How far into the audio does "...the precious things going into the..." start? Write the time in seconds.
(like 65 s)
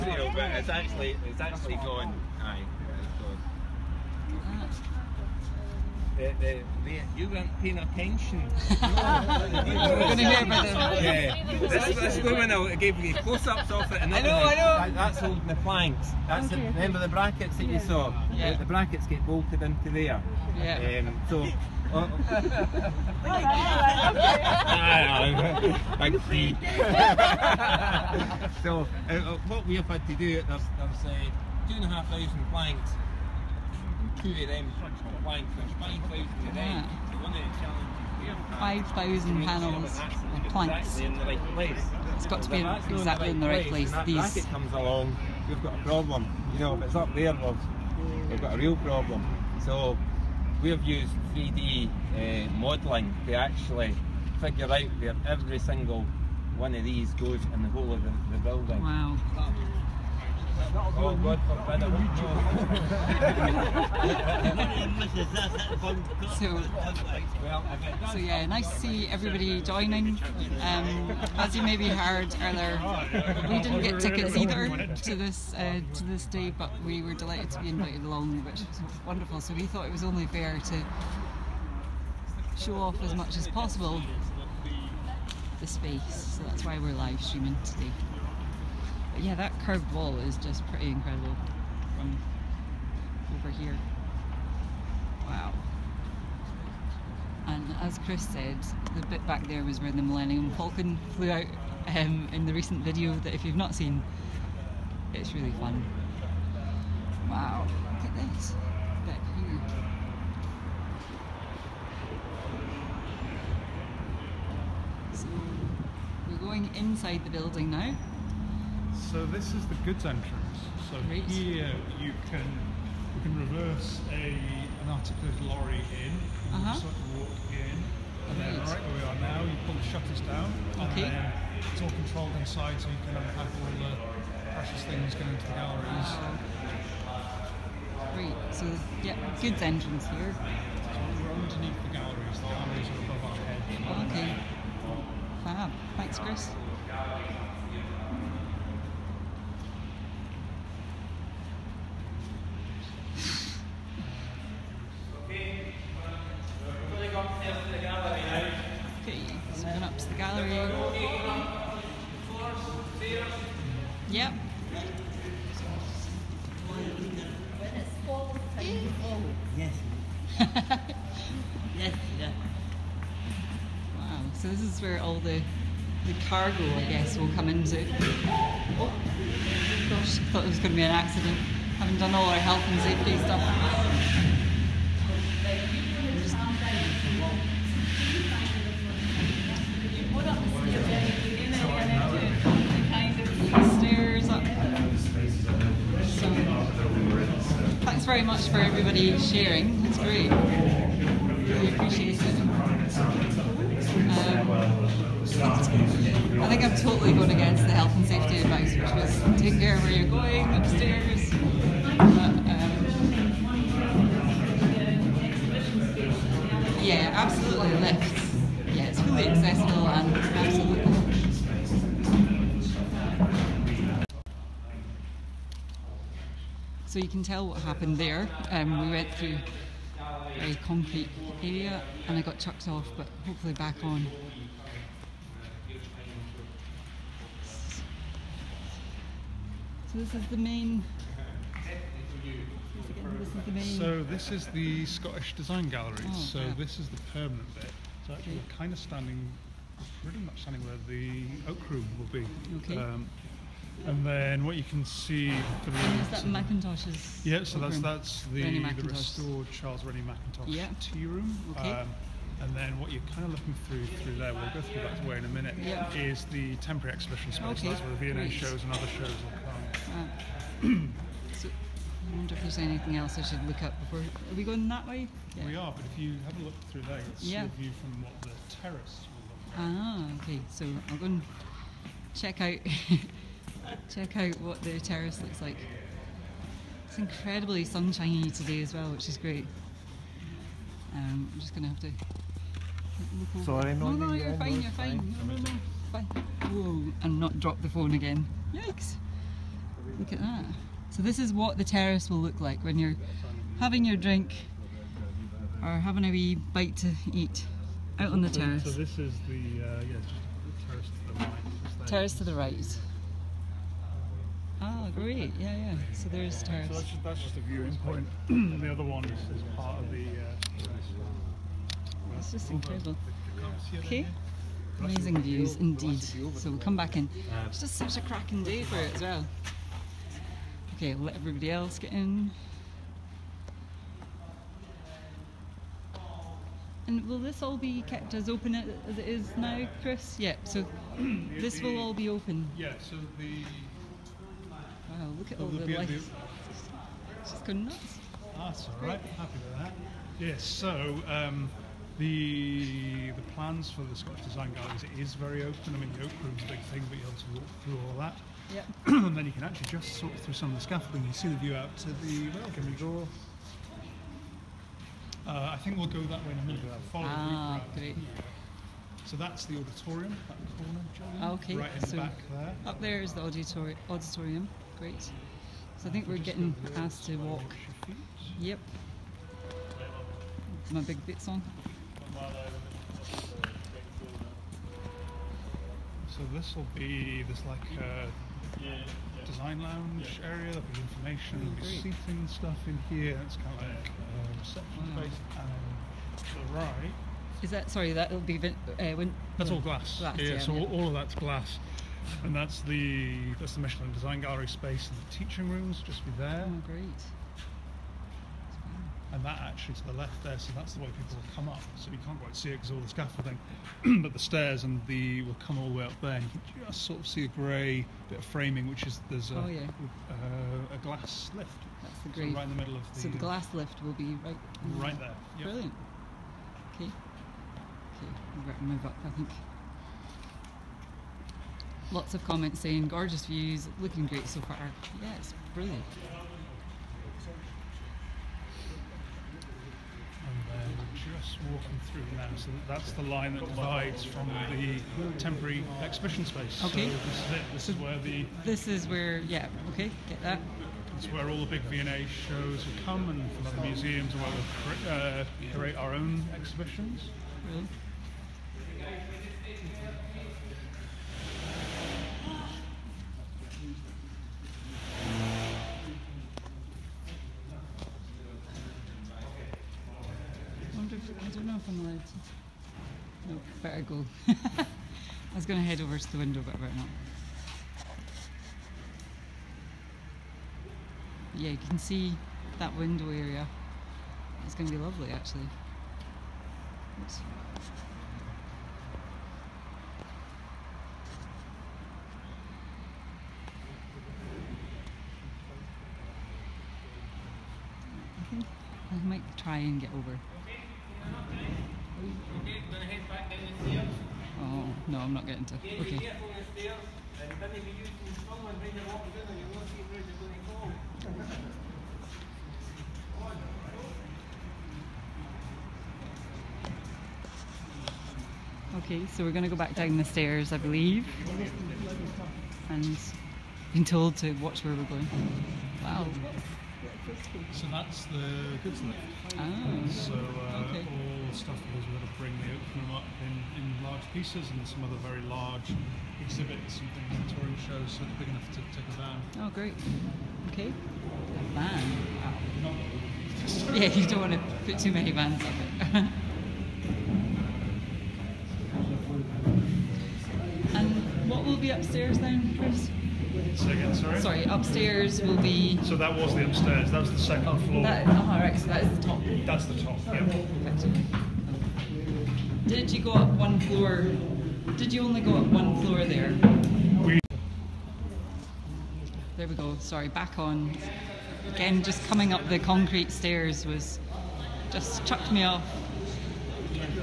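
133 s.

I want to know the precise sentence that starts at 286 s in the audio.
It's incredibly sunshiny today as well, which is great.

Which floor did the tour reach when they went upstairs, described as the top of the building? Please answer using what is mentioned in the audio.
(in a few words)
Second floor.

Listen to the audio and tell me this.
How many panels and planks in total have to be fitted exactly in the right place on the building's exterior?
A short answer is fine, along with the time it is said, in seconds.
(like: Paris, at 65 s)
5,000, at 38 s.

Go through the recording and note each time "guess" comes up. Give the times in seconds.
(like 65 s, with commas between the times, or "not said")
176 s.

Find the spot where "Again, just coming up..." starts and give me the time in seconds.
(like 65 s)
571 s.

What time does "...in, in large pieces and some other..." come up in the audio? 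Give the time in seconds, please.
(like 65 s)
533 s.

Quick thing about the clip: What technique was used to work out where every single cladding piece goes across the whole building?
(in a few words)
3D modelling.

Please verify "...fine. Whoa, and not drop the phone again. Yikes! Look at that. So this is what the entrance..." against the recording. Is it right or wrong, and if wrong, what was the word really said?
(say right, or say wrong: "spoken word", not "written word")
wrong: "terrace", not "entrance".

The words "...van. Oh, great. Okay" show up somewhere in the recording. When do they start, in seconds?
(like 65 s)
538 s.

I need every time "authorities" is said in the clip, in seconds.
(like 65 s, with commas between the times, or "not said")
not said.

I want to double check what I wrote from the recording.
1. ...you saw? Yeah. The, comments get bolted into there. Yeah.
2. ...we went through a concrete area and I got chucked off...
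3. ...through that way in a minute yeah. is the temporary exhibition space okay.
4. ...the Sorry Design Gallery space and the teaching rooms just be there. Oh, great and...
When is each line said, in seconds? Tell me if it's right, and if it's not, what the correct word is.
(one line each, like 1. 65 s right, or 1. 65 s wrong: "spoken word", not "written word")
1. 17 s wrong: "brackets", not "comments"
2. 228 s right
3. 264 s right
4. 403 s wrong: "Michelin", not "Sorry".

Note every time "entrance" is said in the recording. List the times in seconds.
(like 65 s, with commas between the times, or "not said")
120 s, 139 s.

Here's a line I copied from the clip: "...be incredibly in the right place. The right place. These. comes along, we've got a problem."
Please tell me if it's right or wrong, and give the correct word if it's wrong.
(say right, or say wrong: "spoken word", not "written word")
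wrong: "exactly", not "incredibly".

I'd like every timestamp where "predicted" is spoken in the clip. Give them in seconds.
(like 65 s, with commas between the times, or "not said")
not said.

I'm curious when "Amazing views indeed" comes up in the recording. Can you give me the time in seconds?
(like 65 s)
324 s.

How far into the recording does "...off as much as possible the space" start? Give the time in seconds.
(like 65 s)
82 s.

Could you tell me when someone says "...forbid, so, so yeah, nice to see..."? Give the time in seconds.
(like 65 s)
66 s.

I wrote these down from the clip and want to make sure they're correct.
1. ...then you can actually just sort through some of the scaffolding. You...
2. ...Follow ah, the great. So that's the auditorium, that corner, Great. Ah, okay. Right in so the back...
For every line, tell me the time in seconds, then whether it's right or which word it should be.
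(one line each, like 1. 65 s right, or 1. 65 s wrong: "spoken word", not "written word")
1. 359 s right
2. 366 s wrong: "Julian", not "Great".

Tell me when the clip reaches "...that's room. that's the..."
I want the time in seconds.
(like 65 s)
257 s.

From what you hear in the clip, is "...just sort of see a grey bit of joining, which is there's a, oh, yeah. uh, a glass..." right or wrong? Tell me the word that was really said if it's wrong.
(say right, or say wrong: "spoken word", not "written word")
wrong: "framing", not "joining".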